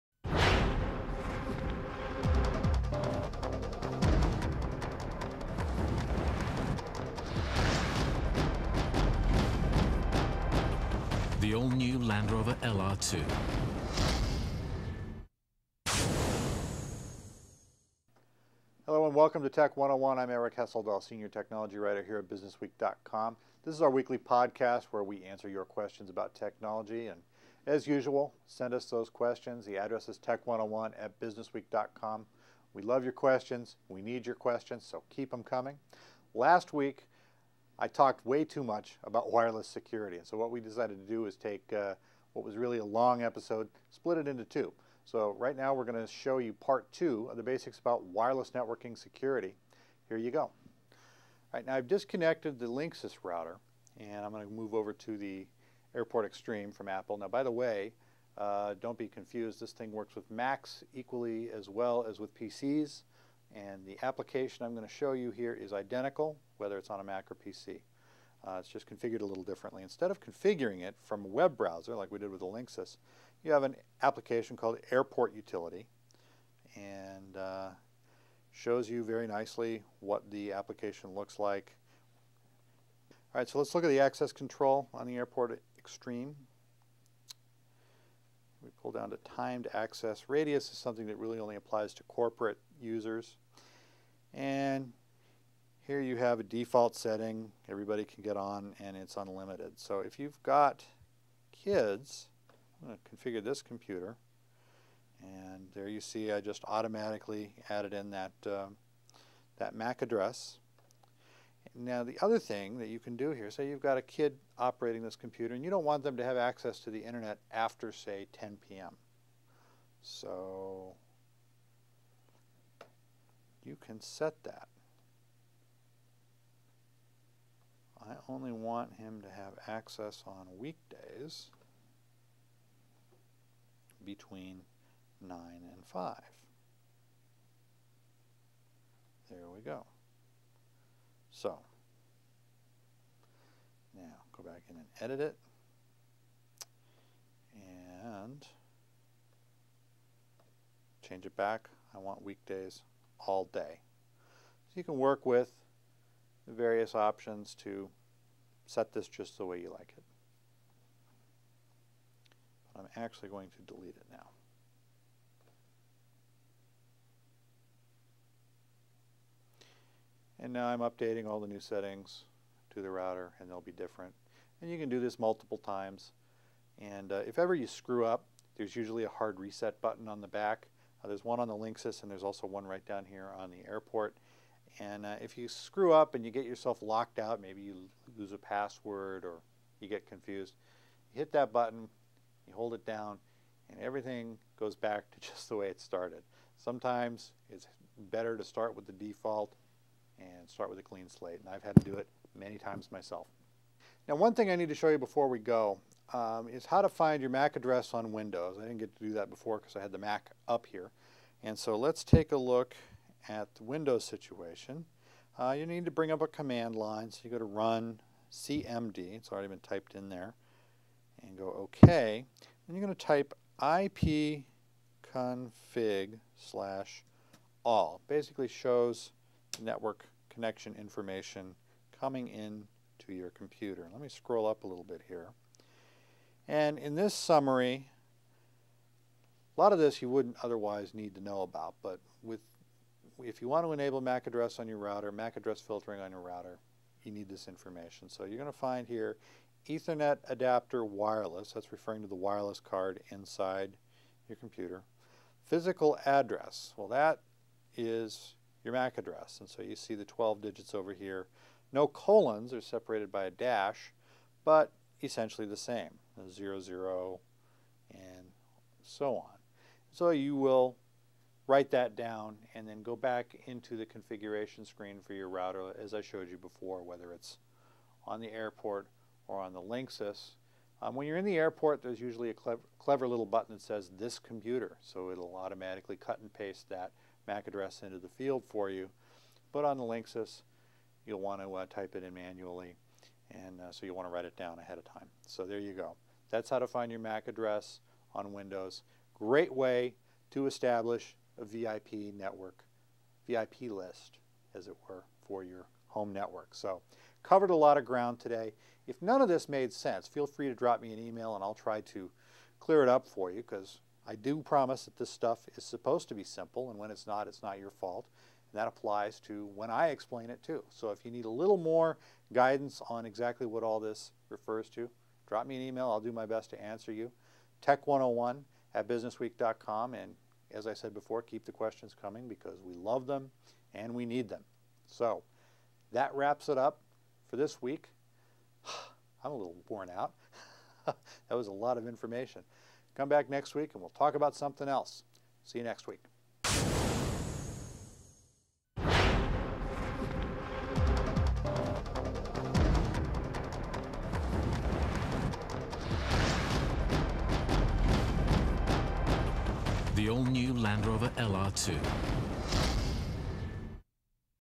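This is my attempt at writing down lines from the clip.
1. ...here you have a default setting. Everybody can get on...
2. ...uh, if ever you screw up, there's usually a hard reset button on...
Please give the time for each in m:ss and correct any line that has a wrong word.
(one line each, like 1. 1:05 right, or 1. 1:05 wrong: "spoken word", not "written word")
1. 1:35 right
2. 2:57 right.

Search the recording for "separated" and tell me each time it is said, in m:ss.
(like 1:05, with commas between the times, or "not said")
4:22.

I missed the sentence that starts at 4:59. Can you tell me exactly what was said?
Great way to establish a VIP network, VIP list, as it were, for your home network.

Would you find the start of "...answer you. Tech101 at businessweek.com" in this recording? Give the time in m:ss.
5:26.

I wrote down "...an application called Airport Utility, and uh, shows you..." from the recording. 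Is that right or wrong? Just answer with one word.
right.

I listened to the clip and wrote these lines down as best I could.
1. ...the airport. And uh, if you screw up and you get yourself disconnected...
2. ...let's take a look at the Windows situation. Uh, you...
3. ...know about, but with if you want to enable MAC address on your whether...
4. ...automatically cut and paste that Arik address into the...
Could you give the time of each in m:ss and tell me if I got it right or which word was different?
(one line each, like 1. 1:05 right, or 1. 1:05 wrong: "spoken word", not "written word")
1. 3:03 wrong: "locked", not "disconnected"
2. 3:31 right
3. 4:01 wrong: "router", not "whether"
4. 4:45 wrong: "MAC", not "Arik".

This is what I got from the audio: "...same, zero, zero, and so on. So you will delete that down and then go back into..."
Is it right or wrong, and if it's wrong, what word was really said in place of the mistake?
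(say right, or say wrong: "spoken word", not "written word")
wrong: "write", not "delete".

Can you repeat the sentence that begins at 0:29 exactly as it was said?
The address is tech101 at businessweek.com.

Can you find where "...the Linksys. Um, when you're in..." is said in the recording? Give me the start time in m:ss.
4:39.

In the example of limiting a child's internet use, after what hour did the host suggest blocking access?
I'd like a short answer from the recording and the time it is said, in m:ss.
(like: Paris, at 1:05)
10 p.m., at 1:58.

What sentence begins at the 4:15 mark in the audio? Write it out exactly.
Physical address, well that is your MAC address.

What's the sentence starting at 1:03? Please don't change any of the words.
And the application I'm going to show you here is identical, whether it's on a Mac or PC.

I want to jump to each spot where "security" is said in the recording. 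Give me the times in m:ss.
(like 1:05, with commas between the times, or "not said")
0:39, 0:48.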